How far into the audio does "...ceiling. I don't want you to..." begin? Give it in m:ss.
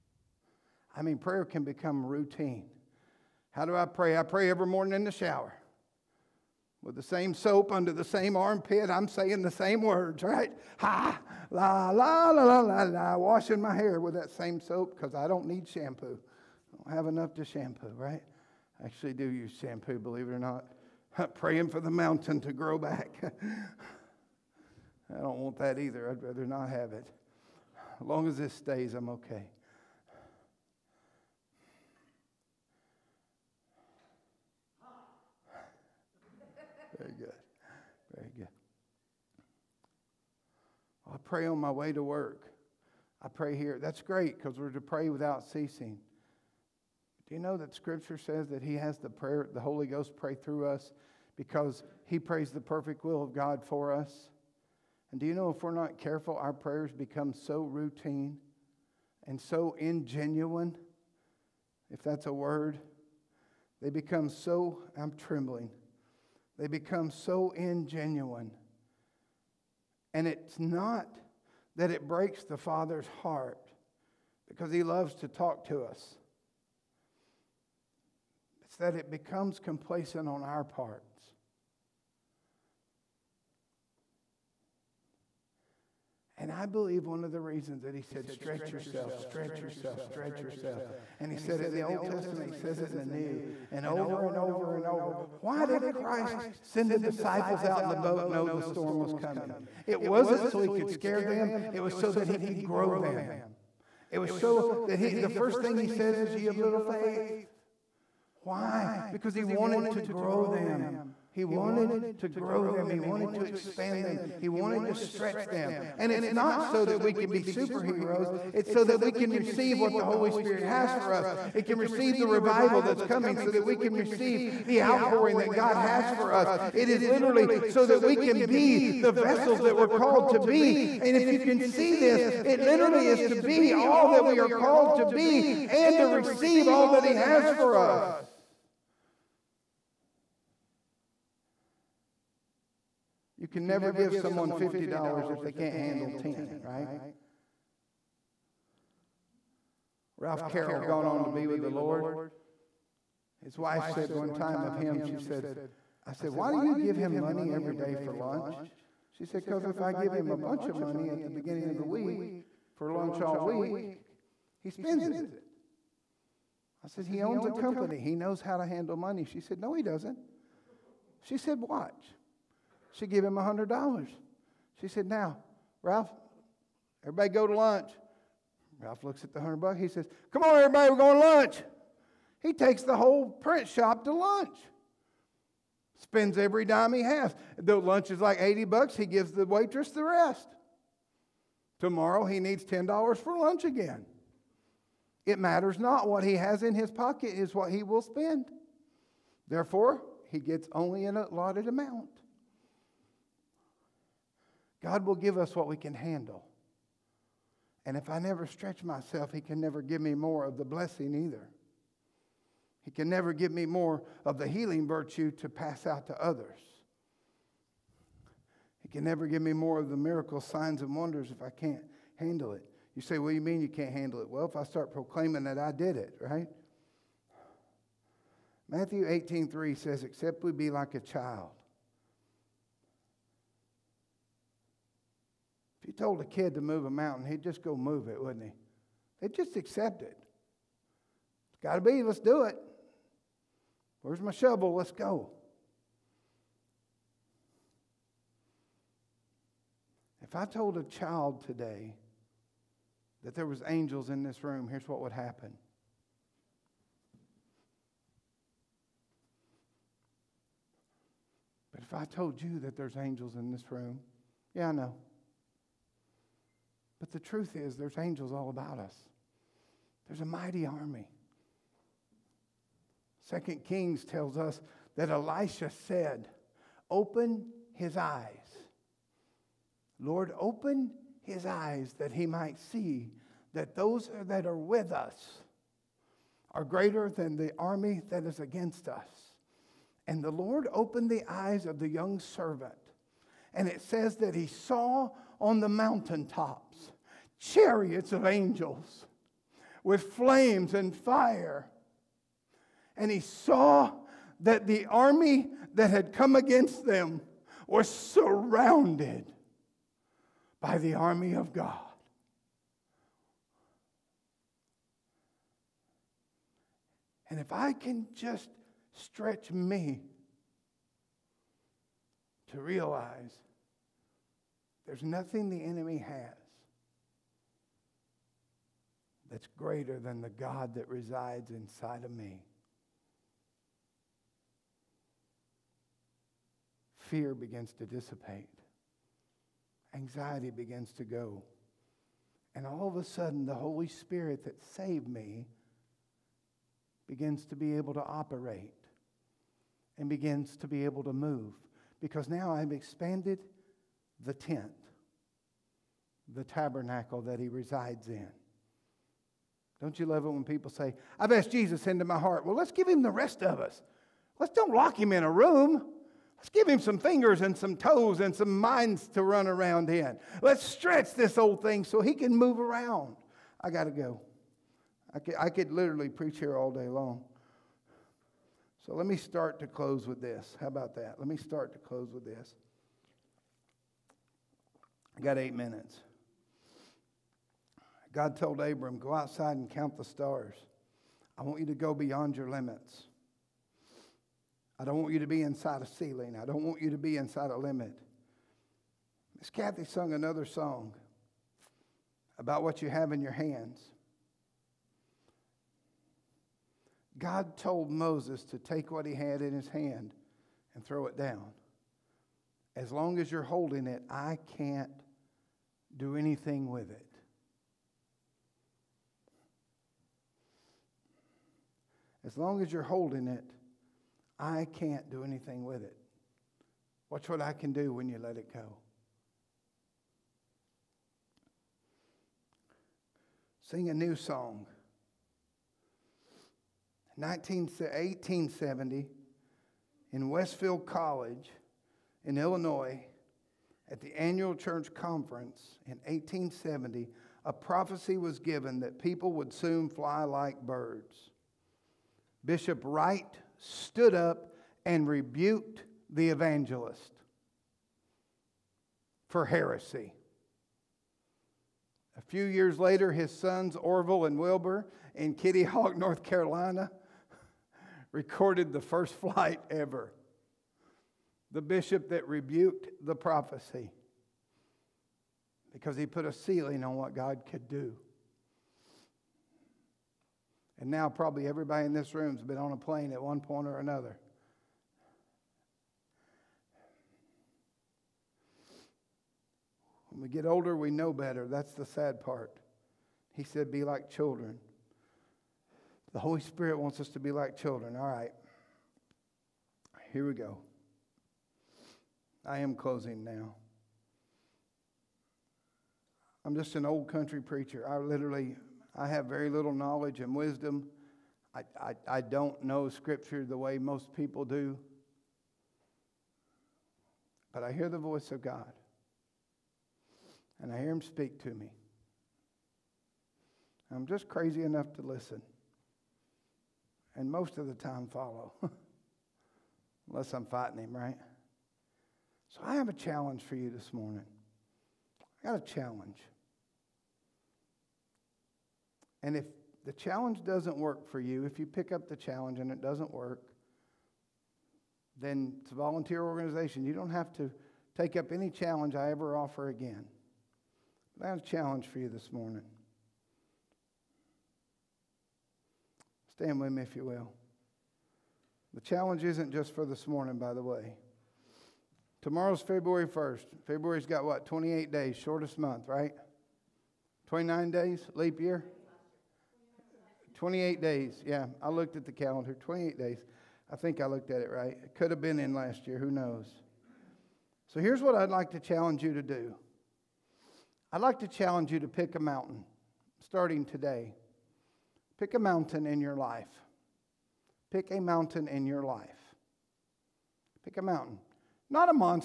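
6:35.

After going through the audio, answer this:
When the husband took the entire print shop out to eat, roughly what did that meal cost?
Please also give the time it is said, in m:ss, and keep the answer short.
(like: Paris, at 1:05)
$80, at 3:08.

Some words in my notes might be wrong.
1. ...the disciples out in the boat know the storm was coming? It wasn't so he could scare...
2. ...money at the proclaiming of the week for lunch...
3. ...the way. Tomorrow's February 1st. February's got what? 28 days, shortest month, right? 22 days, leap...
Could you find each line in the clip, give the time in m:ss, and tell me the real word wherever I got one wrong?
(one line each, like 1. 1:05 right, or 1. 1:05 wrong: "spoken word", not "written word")
1. 1:36 right
2. 2:40 wrong: "beginning", not "proclaiming"
3. 9:20 wrong: "29", not "22".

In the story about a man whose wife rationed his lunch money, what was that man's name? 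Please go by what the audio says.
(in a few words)
Ralph Carroll.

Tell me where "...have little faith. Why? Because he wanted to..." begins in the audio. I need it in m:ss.
1:46.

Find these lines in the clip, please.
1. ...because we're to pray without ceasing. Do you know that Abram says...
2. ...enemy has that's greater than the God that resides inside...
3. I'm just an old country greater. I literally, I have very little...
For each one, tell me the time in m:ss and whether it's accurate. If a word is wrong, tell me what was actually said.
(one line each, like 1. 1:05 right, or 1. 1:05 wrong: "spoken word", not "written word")
1. 0:44 wrong: "Scripture", not "Abram"
2. 5:25 right
3. 8:26 wrong: "preacher", not "greater".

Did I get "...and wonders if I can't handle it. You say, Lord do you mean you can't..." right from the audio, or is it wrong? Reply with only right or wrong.
wrong.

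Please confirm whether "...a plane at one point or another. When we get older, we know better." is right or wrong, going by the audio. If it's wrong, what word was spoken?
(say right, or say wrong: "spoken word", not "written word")
right.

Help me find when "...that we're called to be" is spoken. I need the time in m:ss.
2:09.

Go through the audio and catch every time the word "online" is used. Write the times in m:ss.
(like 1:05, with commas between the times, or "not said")
not said.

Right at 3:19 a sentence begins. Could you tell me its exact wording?
Therefore, he gets only an allotted amount.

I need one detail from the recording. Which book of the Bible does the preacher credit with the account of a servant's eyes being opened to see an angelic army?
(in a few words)
Second Kings.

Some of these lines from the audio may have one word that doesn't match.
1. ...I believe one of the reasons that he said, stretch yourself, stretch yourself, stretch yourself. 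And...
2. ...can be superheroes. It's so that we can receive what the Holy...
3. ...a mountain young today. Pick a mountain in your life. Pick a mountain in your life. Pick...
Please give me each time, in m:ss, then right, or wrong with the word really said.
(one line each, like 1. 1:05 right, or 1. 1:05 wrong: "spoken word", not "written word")
1. 1:26 right
2. 1:57 right
3. 9:42 wrong: "starting", not "young".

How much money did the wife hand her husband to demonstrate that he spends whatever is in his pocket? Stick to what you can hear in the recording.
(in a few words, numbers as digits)
$100.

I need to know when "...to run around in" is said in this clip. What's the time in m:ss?
6:09.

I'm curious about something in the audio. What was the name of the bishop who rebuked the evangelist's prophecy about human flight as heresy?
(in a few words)
Bishop Wright.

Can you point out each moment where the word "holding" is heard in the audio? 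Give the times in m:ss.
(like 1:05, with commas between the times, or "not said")
6:53, 7:02.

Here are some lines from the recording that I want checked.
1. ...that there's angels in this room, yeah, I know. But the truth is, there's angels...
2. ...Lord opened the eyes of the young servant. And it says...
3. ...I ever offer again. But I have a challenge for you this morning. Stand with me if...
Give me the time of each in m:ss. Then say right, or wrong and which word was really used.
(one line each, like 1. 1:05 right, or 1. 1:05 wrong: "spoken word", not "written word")
1. 4:22 right
2. 4:50 right
3. 9:08 right.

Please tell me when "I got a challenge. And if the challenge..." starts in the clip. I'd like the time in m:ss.
8:55.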